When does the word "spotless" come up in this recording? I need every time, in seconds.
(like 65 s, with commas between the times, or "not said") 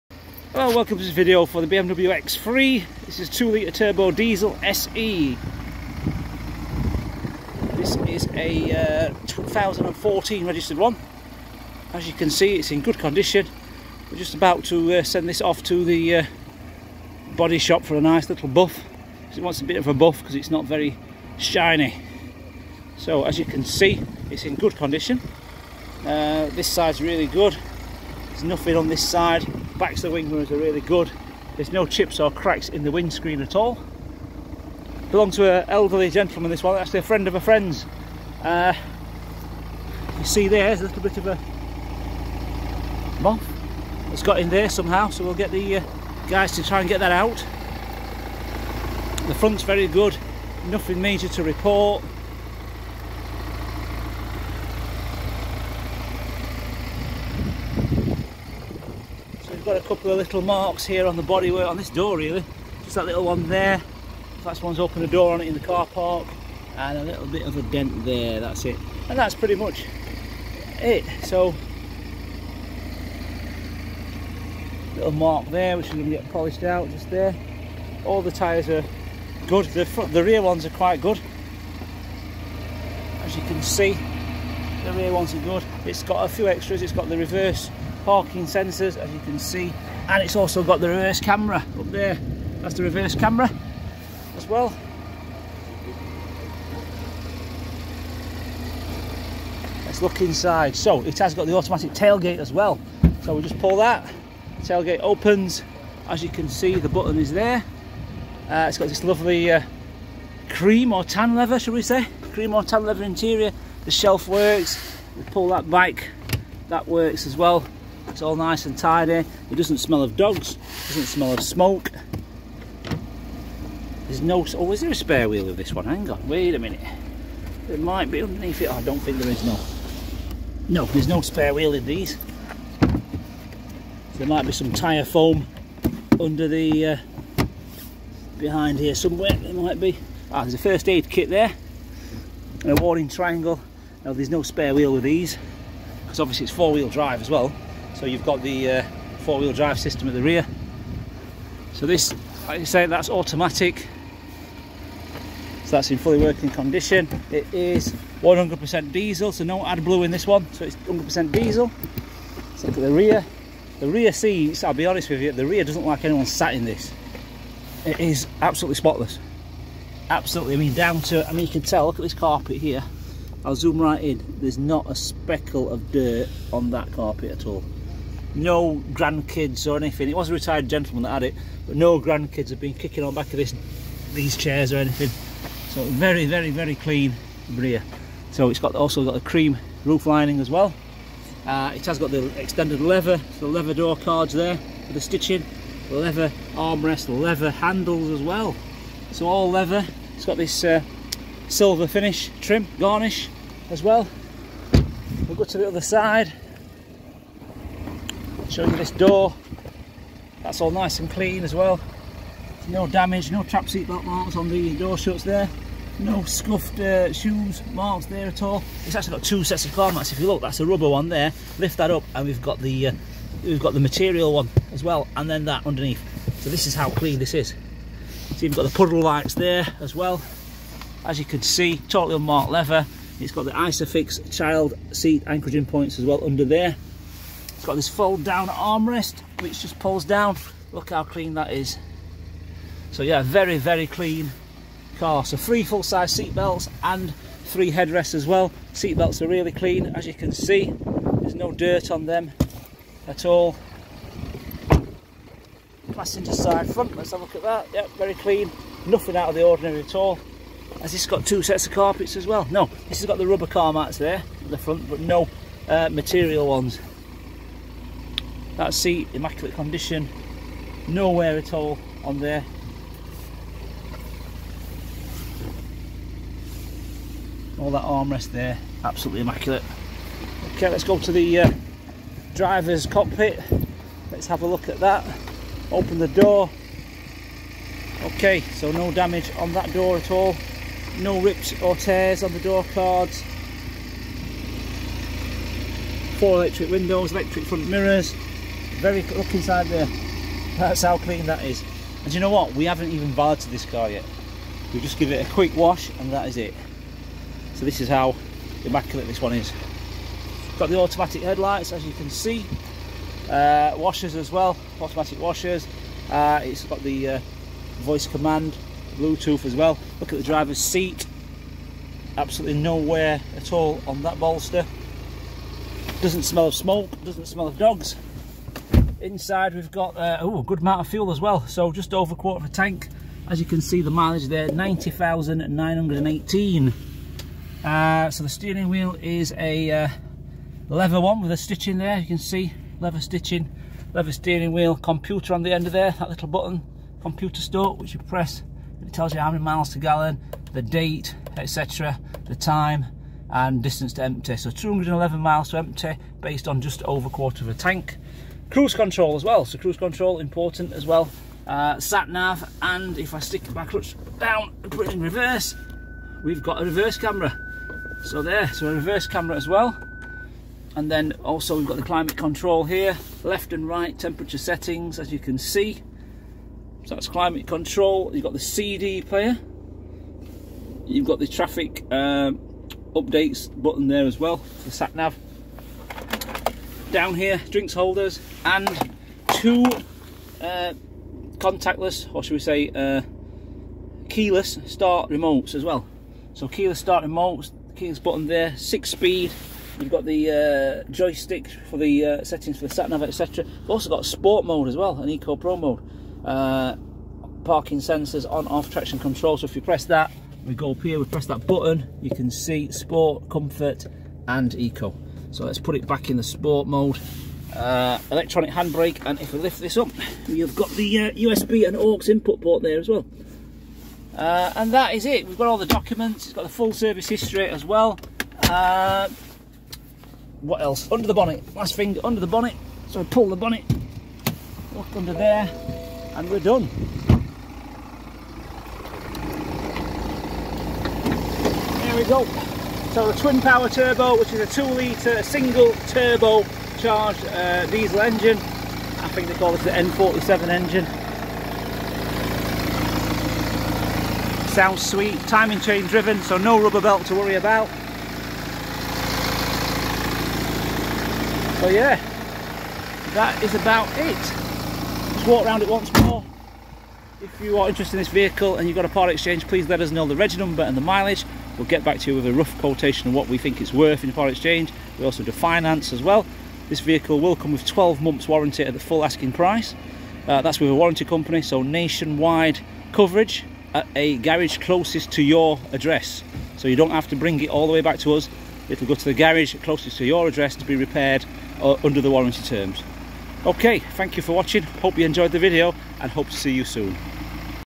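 168 s.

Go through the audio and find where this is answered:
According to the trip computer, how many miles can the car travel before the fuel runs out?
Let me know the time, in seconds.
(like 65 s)
354 s.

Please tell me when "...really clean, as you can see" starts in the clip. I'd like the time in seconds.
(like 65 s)
249 s.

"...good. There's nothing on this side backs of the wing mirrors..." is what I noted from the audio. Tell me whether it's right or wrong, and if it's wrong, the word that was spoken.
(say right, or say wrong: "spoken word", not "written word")
right.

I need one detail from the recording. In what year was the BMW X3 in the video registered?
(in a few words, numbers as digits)
2014.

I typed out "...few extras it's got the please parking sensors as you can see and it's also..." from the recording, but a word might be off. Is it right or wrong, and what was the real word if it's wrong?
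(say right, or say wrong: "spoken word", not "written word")
wrong: "reverse", not "please".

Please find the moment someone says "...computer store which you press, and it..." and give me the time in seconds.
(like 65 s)
347 s.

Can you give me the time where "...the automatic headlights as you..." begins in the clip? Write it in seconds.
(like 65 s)
310 s.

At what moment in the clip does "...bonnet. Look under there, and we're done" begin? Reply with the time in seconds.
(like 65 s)
433 s.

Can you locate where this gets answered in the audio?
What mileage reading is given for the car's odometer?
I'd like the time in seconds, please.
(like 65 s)
334 s.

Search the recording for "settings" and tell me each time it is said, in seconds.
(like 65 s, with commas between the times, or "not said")
374 s, 402 s.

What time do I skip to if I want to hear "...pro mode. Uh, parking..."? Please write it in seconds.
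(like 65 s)
405 s.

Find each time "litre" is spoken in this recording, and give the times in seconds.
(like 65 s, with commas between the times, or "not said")
3 s, 444 s.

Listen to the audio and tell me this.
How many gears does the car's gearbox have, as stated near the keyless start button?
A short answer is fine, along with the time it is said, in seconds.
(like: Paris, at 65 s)
6, at 398 s.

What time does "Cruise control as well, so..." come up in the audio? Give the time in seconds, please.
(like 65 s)
358 s.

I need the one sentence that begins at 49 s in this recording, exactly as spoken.
The front's very good, nothing major to report.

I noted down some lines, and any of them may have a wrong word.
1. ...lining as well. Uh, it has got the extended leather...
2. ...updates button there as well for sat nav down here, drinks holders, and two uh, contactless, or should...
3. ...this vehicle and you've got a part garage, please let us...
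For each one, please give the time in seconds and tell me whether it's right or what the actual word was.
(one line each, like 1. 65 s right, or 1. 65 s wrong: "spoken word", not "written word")
1. 190 s right
2. 382 s right
3. 467 s wrong: "exchange", not "garage".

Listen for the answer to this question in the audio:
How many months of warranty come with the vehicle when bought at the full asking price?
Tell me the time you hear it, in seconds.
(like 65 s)
477 s.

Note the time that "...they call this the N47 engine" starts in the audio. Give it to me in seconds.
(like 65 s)
449 s.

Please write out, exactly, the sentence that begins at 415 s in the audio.
So let's put it back in the sport mode.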